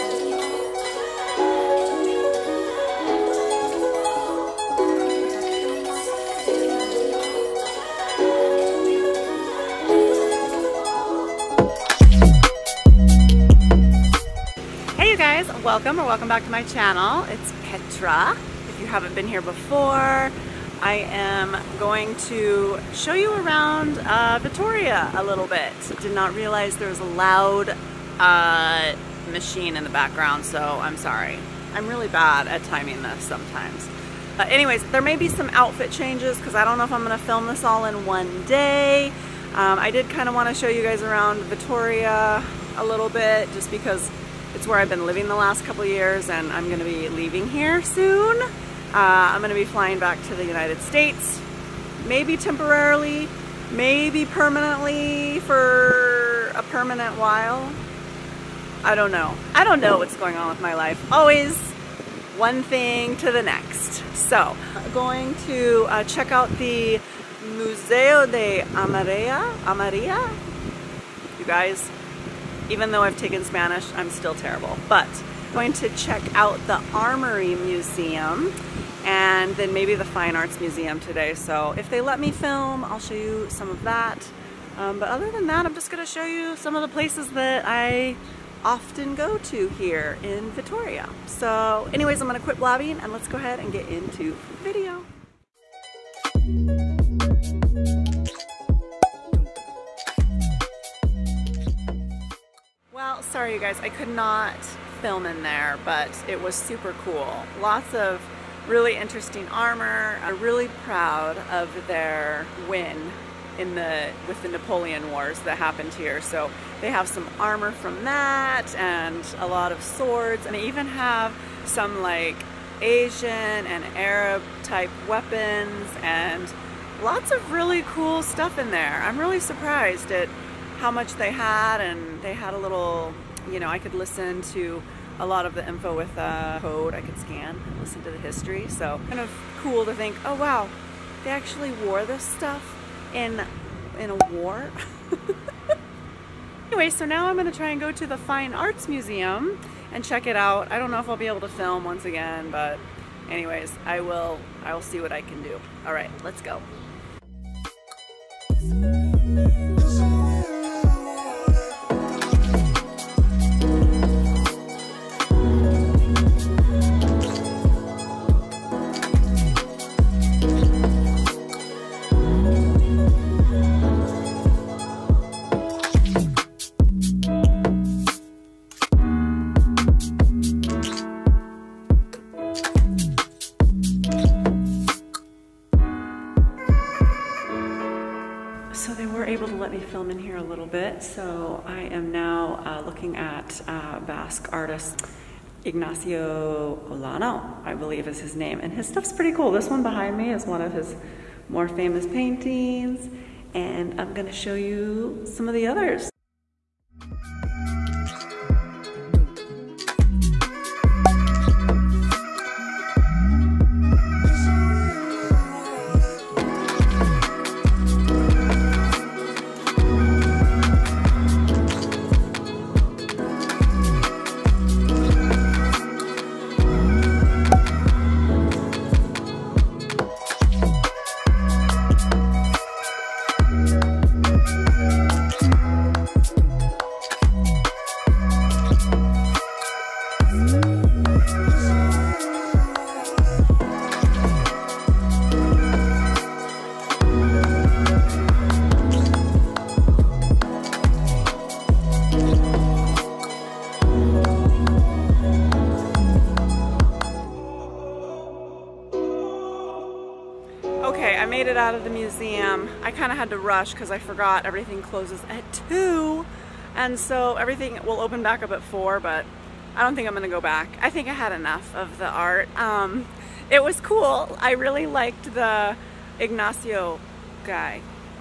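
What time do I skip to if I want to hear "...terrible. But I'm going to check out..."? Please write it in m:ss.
1:14.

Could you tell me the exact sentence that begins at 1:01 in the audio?
Always one thing to the next.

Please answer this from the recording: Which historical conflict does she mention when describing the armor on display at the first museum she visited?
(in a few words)
Napoleon Wars.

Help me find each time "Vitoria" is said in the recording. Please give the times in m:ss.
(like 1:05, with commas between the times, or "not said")
0:24, 0:41, 1:30.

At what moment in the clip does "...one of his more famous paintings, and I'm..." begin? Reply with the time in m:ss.
3:20.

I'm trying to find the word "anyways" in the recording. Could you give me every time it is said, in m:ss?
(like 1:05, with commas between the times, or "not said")
0:34, 1:31, 2:26, 2:33.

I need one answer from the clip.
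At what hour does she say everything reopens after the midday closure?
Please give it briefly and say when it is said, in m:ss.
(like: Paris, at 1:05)
4, at 4:28.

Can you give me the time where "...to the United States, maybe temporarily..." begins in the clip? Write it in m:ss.
0:50.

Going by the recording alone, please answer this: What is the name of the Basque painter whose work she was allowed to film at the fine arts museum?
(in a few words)
Ignacio Olano.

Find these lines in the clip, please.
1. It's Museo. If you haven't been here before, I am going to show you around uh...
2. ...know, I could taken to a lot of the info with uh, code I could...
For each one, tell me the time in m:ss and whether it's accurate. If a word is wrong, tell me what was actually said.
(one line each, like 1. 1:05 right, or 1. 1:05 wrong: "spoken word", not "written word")
1. 0:17 wrong: "Petra", not "Museo"
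2. 2:13 wrong: "listen", not "taken".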